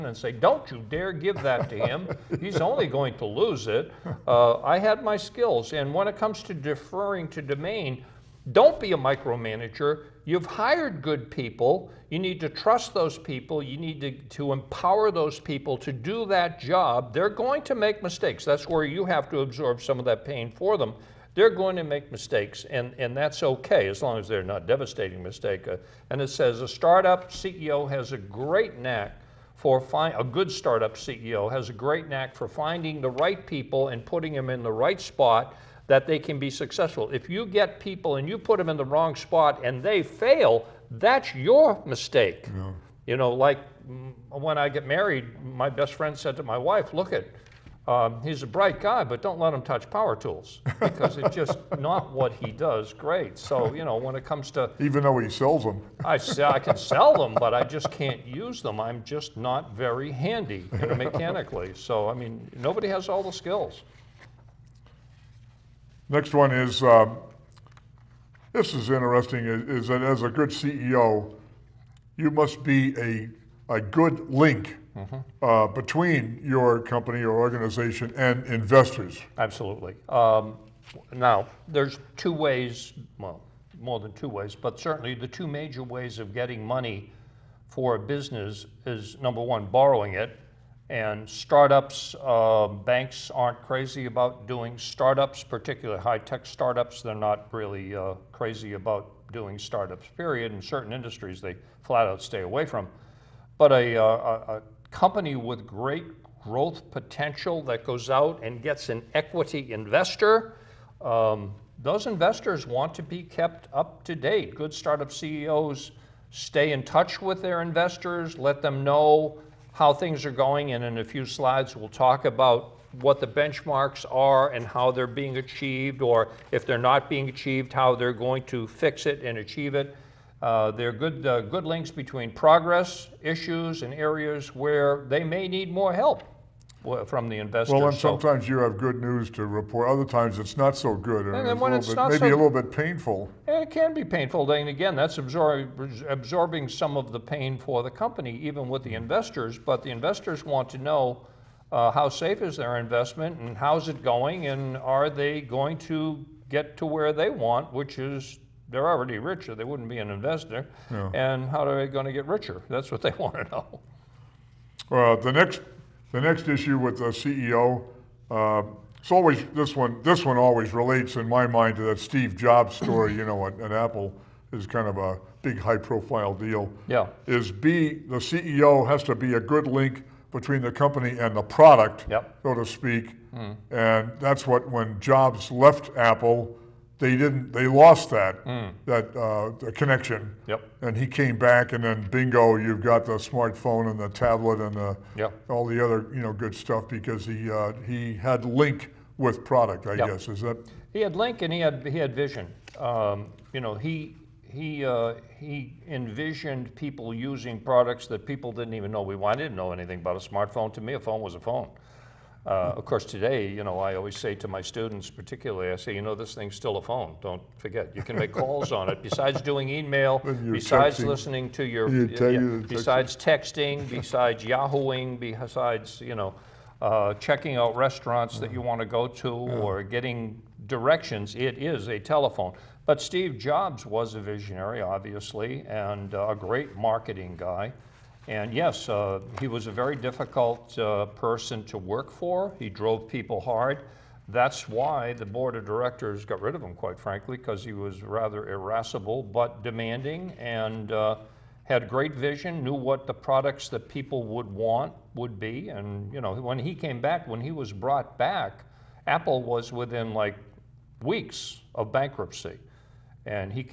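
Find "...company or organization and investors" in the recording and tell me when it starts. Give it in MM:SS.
01:16.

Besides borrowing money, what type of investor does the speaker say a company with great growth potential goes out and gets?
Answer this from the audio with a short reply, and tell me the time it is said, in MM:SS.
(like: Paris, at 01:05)
equity investor, at 01:49.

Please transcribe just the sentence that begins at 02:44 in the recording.
Well, the next the next issue with the CEO, uh, um, it's always this one.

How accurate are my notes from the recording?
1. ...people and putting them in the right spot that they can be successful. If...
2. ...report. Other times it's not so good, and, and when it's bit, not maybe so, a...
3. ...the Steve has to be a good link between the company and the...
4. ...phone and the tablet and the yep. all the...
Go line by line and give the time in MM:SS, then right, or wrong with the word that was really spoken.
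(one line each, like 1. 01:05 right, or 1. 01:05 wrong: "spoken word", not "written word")
1. 00:33 right
2. 02:19 right
3. 02:57 wrong: "CEO", not "Steve"
4. 03:13 wrong: "smartphone", not "phone".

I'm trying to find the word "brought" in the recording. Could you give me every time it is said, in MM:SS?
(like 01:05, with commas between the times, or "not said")
04:17.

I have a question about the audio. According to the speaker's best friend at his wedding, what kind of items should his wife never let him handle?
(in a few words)
power tools.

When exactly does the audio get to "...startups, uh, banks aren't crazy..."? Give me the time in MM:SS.
01:31.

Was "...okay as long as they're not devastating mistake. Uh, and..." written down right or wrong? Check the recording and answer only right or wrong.
right.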